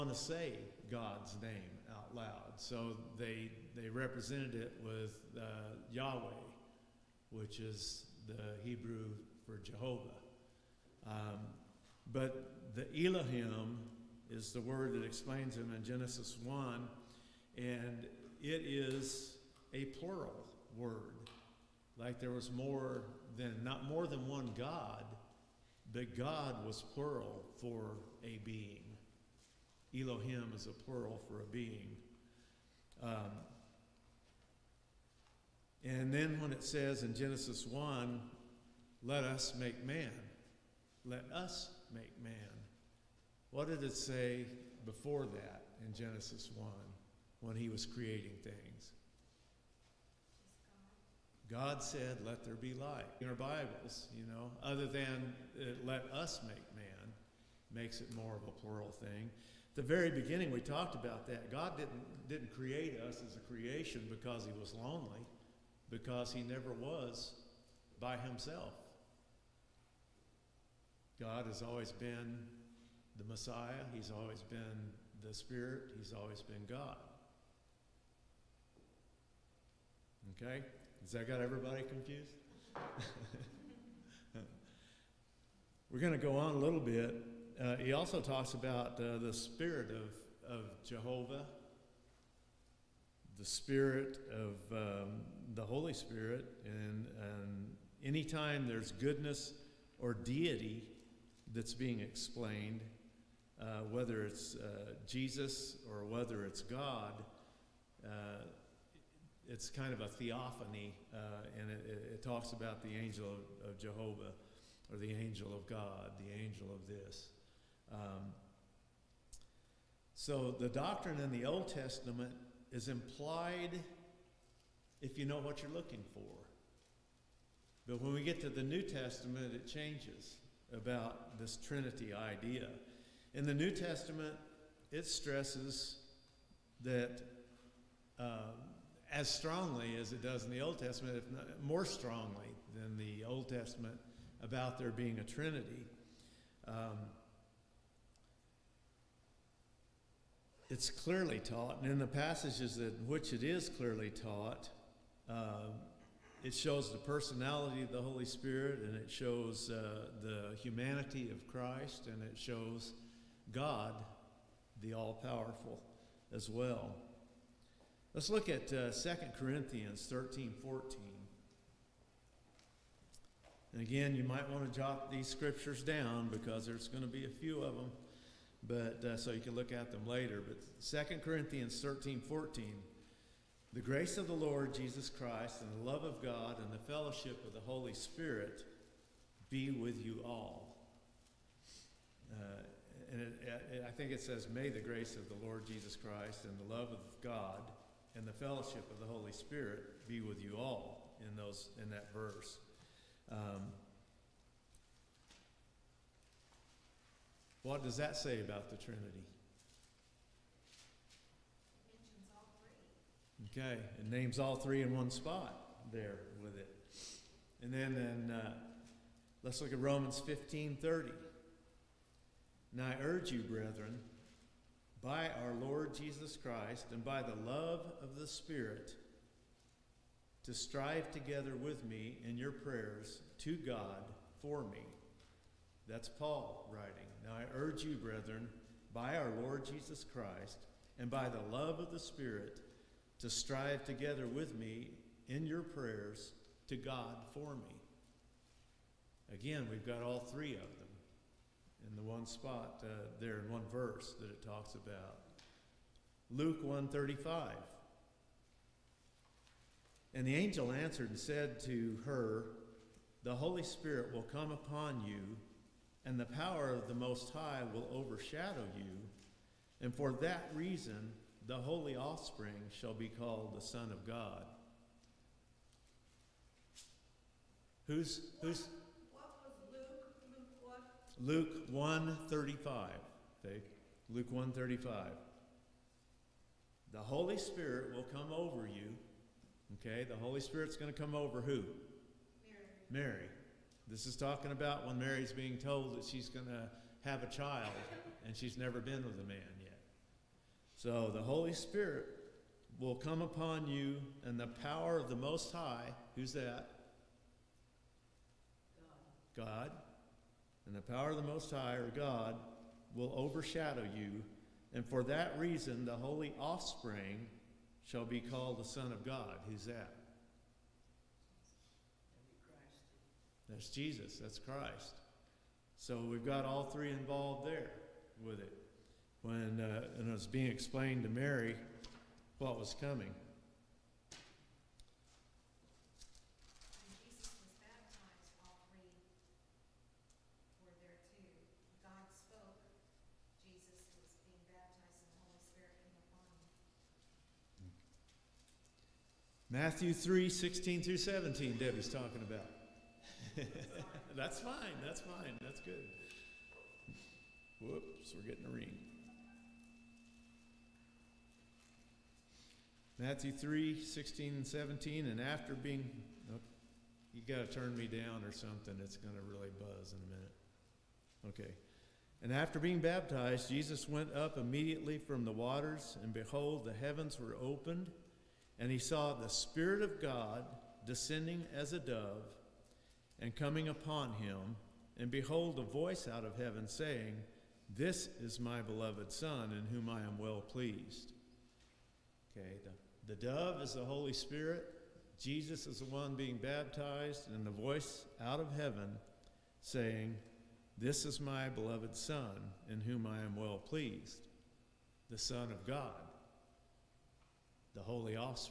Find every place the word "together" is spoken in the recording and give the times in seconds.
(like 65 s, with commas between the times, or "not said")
231 s, 243 s.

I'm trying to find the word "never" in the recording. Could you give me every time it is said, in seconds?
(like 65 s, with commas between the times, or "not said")
66 s, 298 s.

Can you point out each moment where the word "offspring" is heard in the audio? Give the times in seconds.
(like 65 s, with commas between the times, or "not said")
271 s, 316 s.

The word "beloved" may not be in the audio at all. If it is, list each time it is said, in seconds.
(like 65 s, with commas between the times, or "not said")
388 s, 401 s.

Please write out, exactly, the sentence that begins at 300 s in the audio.
So the Holy Spirit will come upon you and the power of the Most High.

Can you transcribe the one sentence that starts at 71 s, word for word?
God has always been the Messiah, he's always been the Spirit, he's always been God.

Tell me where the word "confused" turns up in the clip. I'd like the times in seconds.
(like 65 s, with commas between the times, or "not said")
81 s.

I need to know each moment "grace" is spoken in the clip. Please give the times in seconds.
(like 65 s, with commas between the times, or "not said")
183 s, 194 s.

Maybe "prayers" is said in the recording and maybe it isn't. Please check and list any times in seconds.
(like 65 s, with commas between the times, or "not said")
232 s, 245 s.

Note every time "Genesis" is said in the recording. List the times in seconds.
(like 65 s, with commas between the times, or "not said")
15 s, 37 s, 45 s.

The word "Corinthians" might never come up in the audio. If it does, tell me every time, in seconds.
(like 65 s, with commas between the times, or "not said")
169 s, 181 s.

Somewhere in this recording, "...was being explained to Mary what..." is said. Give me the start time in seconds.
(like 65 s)
330 s.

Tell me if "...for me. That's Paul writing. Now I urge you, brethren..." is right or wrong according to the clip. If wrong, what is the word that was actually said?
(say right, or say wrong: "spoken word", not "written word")
right.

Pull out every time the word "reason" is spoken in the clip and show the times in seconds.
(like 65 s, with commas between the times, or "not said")
270 s, 315 s.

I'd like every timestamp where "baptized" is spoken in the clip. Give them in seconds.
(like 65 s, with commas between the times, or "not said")
372 s, 396 s.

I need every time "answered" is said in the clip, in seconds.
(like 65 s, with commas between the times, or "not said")
260 s.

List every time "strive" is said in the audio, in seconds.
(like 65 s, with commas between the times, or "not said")
230 s, 243 s.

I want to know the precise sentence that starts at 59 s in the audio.
The very beginning, we talked about that.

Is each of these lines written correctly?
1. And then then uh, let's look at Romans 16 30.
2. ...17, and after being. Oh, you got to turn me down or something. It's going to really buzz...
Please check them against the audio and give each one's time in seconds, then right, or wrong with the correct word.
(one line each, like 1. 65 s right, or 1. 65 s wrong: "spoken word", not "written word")
1. 217 s wrong: "15", not "16"
2. 364 s right.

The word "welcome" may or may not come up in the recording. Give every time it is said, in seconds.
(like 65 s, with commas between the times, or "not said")
not said.